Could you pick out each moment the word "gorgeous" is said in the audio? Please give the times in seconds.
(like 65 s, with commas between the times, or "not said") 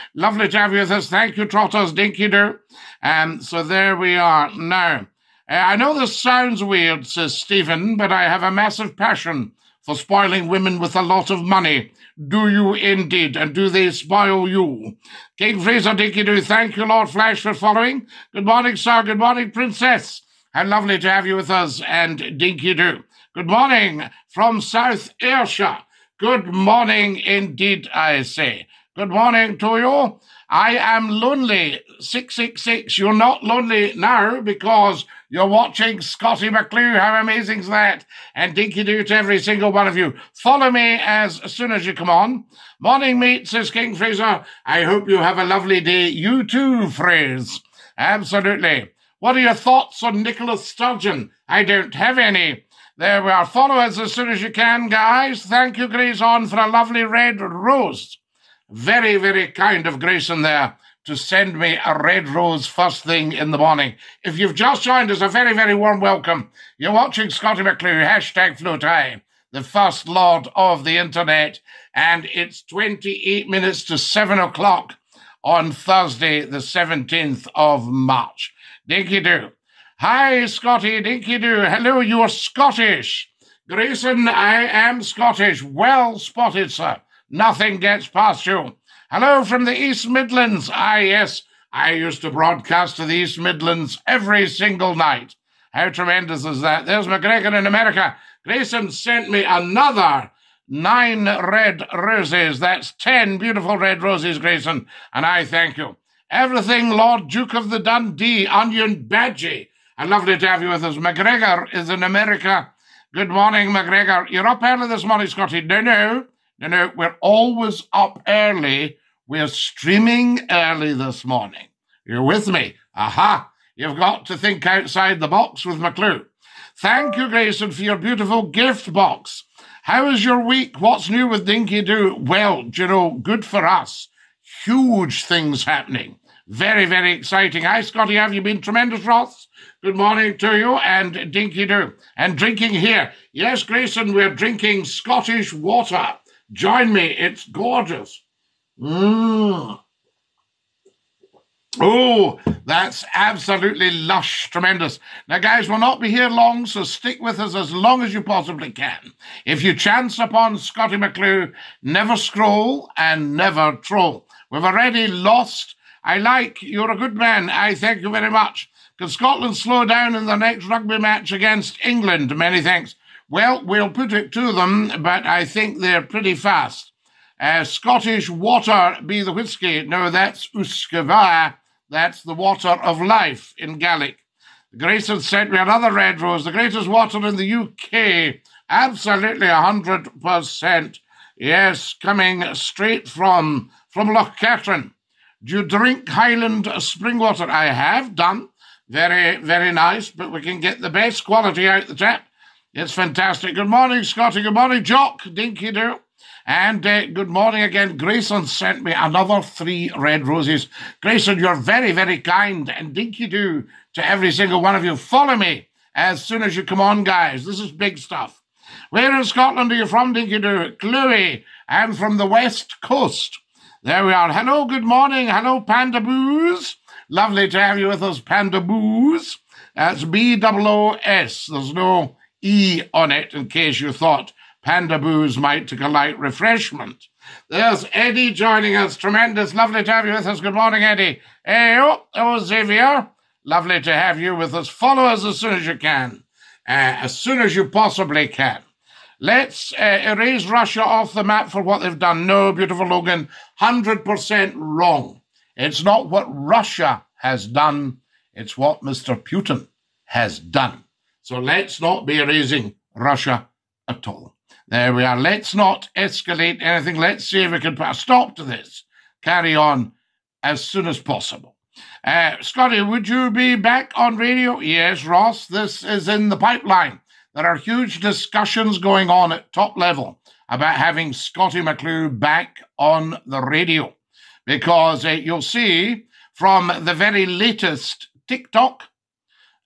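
147 s.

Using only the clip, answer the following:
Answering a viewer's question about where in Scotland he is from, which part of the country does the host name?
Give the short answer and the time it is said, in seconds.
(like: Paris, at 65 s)
West Coast, at 222 s.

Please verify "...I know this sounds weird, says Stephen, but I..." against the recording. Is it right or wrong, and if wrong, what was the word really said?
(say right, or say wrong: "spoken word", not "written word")
right.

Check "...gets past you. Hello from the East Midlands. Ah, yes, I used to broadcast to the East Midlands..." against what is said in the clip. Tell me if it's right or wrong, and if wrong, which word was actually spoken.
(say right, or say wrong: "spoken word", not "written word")
right.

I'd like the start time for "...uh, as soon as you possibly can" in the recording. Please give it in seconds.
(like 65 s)
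246 s.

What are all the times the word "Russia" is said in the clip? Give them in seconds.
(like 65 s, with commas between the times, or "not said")
250 s, 256 s, 262 s.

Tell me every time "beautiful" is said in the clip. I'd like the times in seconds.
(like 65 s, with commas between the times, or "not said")
103 s, 127 s, 252 s.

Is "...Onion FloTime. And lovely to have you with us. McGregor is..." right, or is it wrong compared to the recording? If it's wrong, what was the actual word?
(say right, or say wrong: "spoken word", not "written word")
wrong: "Badgie", not "FloTime".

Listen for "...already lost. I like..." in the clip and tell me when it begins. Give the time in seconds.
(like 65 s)
164 s.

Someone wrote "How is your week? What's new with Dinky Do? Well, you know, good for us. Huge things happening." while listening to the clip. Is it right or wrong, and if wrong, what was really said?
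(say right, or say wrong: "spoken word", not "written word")
right.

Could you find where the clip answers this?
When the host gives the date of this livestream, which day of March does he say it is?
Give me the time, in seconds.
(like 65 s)
76 s.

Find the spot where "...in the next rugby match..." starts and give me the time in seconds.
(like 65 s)
170 s.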